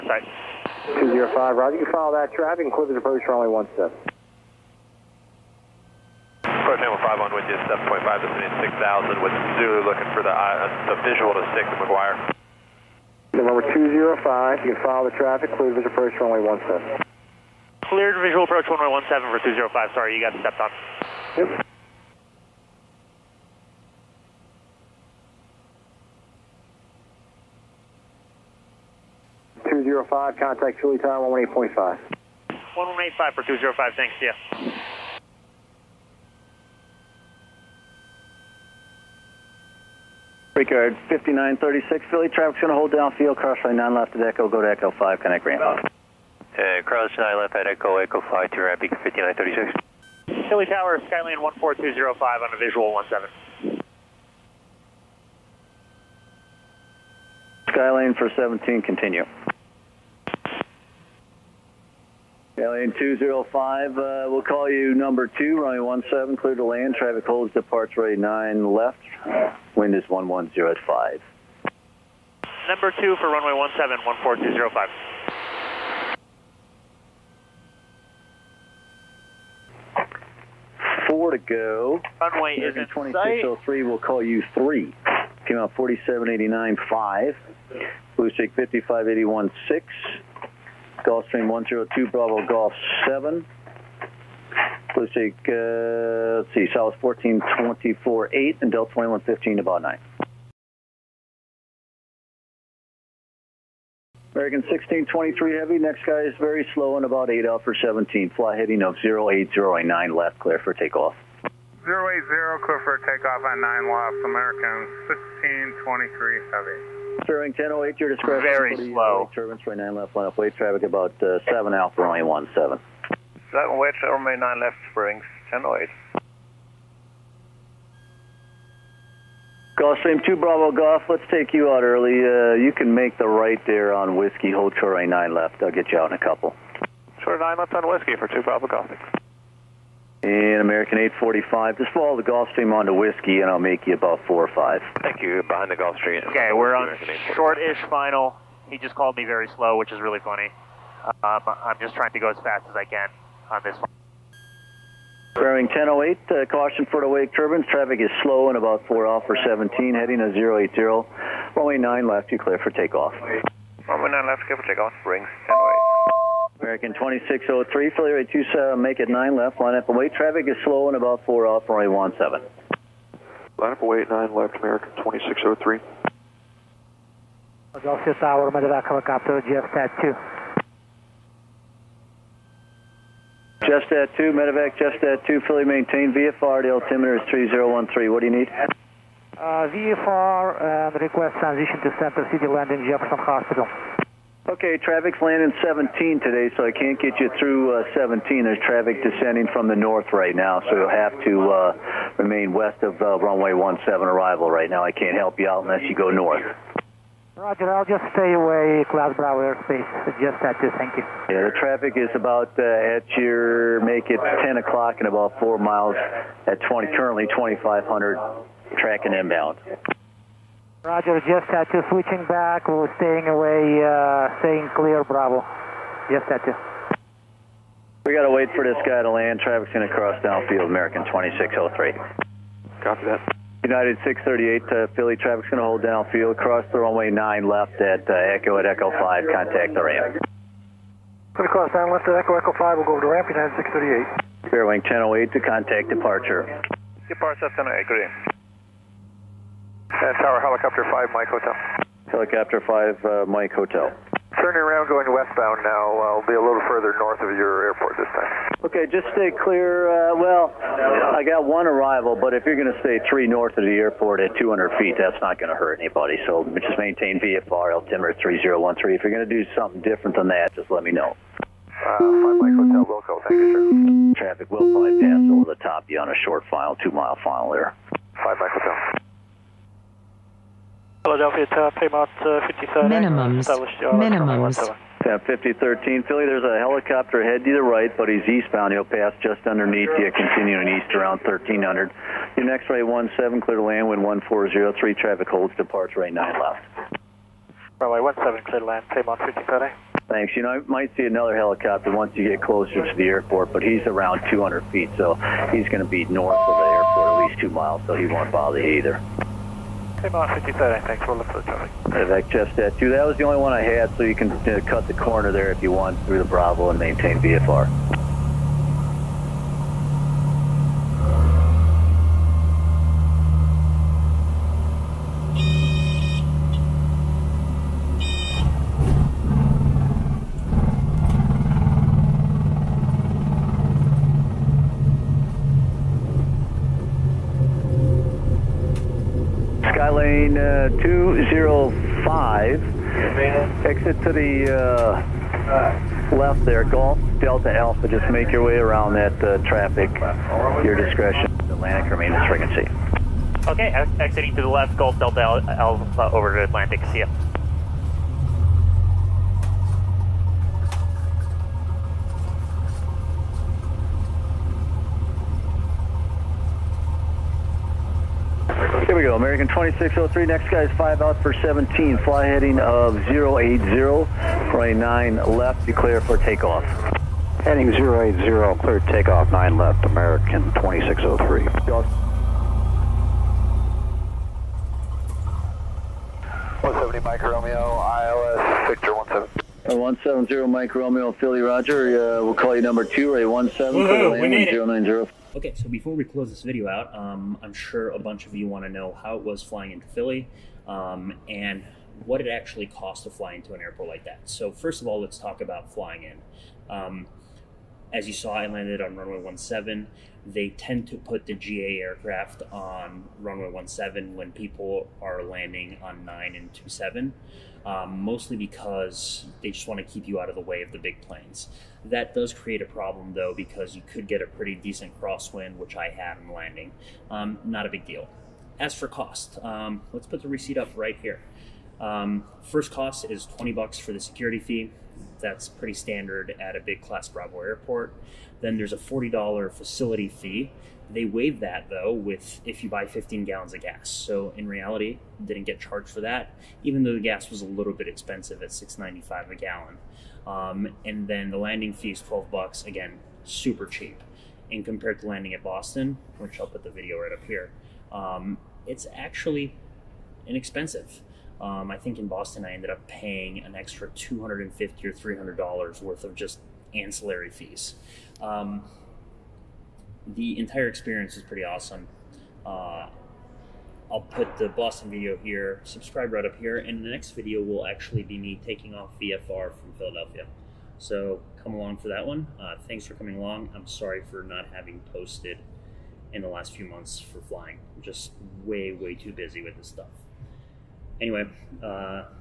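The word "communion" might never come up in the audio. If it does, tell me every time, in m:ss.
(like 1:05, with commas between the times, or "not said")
not said.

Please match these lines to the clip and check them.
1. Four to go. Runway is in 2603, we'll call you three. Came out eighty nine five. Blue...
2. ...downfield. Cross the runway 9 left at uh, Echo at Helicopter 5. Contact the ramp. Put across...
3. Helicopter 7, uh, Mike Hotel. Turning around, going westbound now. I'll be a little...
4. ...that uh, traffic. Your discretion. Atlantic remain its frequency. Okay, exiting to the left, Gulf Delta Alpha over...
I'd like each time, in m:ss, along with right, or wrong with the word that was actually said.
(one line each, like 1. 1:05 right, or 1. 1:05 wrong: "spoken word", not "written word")
1. 1:21 right
2. 3:55 wrong: "Echo", not "Helicopter"
3. 4:12 wrong: "5", not "7"
4. 5:48 right.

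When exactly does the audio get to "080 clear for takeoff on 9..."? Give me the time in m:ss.
1:51.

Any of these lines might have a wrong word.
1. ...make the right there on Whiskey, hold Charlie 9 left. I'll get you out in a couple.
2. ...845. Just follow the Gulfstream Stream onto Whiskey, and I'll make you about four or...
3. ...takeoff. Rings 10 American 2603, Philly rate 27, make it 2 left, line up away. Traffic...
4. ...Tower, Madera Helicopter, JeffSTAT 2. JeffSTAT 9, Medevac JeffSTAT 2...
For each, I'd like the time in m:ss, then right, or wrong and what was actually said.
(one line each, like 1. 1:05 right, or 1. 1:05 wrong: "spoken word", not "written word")
1. 2:12 right
2. 2:20 right
3. 2:44 wrong: "9", not "2"
4. 2:58 wrong: "2", not "9".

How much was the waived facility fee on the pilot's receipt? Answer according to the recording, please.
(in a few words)
$40.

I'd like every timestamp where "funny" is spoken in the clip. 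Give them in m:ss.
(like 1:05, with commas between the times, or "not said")
2:30.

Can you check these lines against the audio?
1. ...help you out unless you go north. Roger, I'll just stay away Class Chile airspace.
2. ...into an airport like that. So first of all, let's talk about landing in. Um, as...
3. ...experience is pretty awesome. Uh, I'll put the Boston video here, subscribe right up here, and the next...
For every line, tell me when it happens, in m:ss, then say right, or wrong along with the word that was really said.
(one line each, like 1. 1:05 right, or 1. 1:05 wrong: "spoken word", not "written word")
1. 3:25 wrong: "Bravo", not "Chile"
2. 6:43 wrong: "flying", not "landing"
3. 7:50 right.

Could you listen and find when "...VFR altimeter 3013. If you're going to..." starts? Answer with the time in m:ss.
4:27.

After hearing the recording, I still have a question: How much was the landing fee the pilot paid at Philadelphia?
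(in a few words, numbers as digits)
$12.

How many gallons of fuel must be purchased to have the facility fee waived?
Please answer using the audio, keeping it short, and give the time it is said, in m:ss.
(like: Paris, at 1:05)
15 gallons, at 7:22.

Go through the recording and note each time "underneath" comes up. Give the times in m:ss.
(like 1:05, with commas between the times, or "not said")
4:49.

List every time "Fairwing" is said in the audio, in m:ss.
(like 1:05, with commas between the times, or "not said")
4:04.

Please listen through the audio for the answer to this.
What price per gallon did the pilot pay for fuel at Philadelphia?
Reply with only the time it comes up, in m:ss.
7:28.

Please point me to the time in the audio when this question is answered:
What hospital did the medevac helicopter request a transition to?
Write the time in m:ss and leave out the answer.
3:12.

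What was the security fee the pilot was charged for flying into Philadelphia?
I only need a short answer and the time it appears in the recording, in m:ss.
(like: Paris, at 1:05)
$20, at 7:13.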